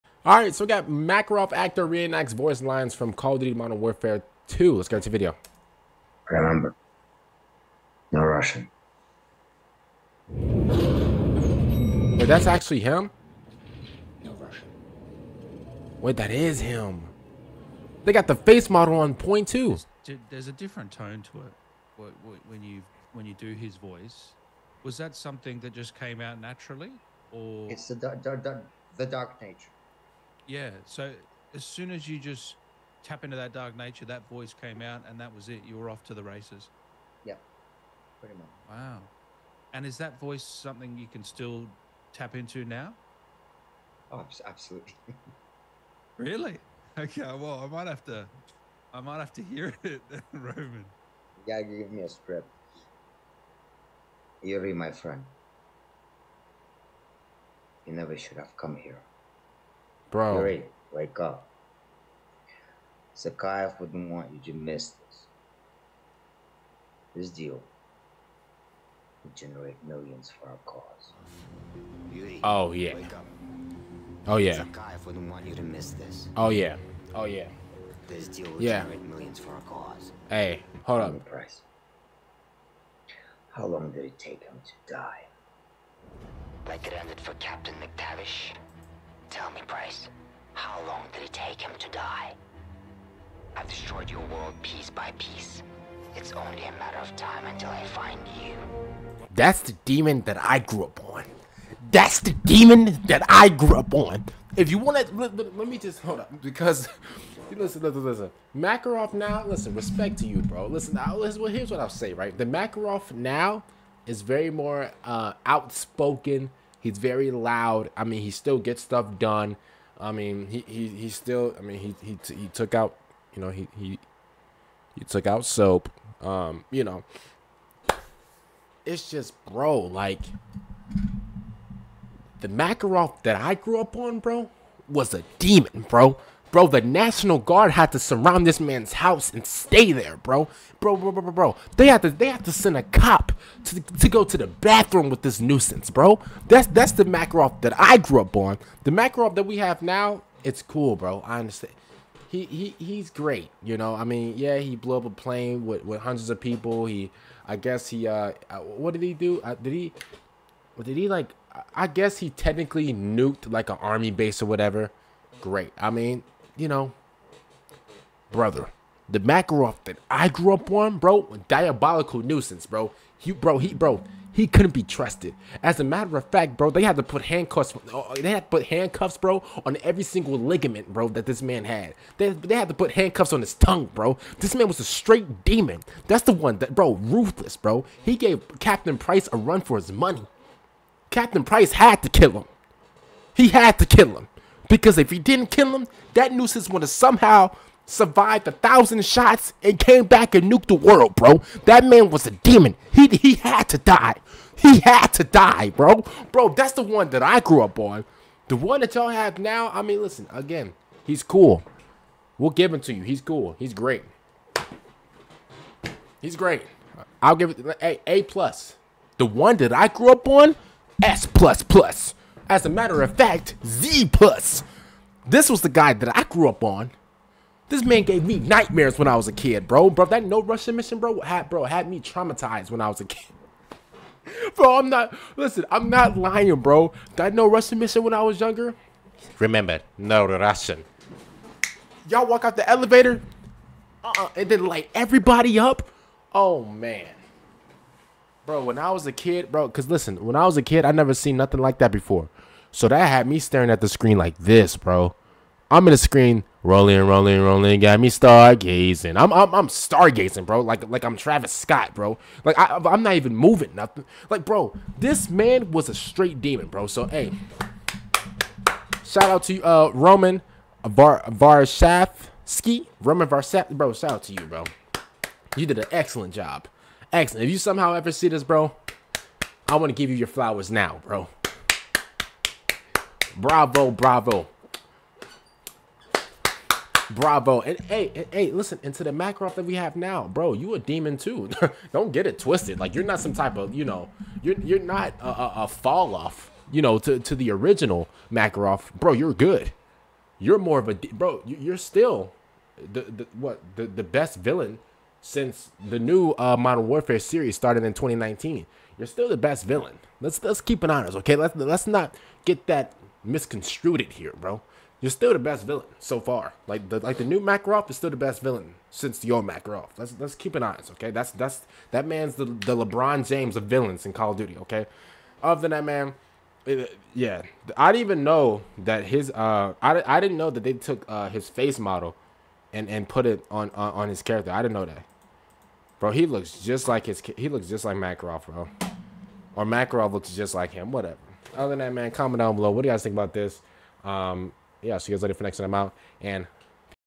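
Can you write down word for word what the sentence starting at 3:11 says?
Captain Price had to kill him.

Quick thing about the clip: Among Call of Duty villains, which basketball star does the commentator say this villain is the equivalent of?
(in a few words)
LeBron James.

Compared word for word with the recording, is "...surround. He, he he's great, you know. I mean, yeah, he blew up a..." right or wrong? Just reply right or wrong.
wrong.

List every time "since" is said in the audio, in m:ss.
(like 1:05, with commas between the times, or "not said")
5:05, 5:18.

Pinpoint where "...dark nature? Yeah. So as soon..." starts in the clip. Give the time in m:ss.
0:29.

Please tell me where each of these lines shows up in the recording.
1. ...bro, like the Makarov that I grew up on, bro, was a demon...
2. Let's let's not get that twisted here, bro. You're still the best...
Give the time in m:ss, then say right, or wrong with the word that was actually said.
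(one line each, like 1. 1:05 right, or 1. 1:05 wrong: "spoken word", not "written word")
1. 2:09 right
2. 5:11 wrong: "misconstrued", not "twisted".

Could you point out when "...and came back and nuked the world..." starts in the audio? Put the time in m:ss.
3:19.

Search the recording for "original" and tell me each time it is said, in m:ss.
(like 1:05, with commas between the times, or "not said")
4:57.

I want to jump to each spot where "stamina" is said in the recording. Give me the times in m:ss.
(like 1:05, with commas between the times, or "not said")
not said.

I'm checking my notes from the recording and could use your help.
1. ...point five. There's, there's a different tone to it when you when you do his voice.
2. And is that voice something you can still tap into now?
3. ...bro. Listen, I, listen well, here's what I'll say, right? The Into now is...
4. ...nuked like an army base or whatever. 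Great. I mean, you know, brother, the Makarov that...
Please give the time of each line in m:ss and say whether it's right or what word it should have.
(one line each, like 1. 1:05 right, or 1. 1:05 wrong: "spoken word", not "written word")
1. 0:19 wrong: "two", not "five"
2. 0:39 right
3. 1:50 wrong: "Makarov", not "Into"
4. 2:42 right.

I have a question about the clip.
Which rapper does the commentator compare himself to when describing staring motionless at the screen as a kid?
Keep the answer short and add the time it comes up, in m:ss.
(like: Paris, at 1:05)
Travis Scott, at 4:21.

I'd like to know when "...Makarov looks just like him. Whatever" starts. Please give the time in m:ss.
5:39.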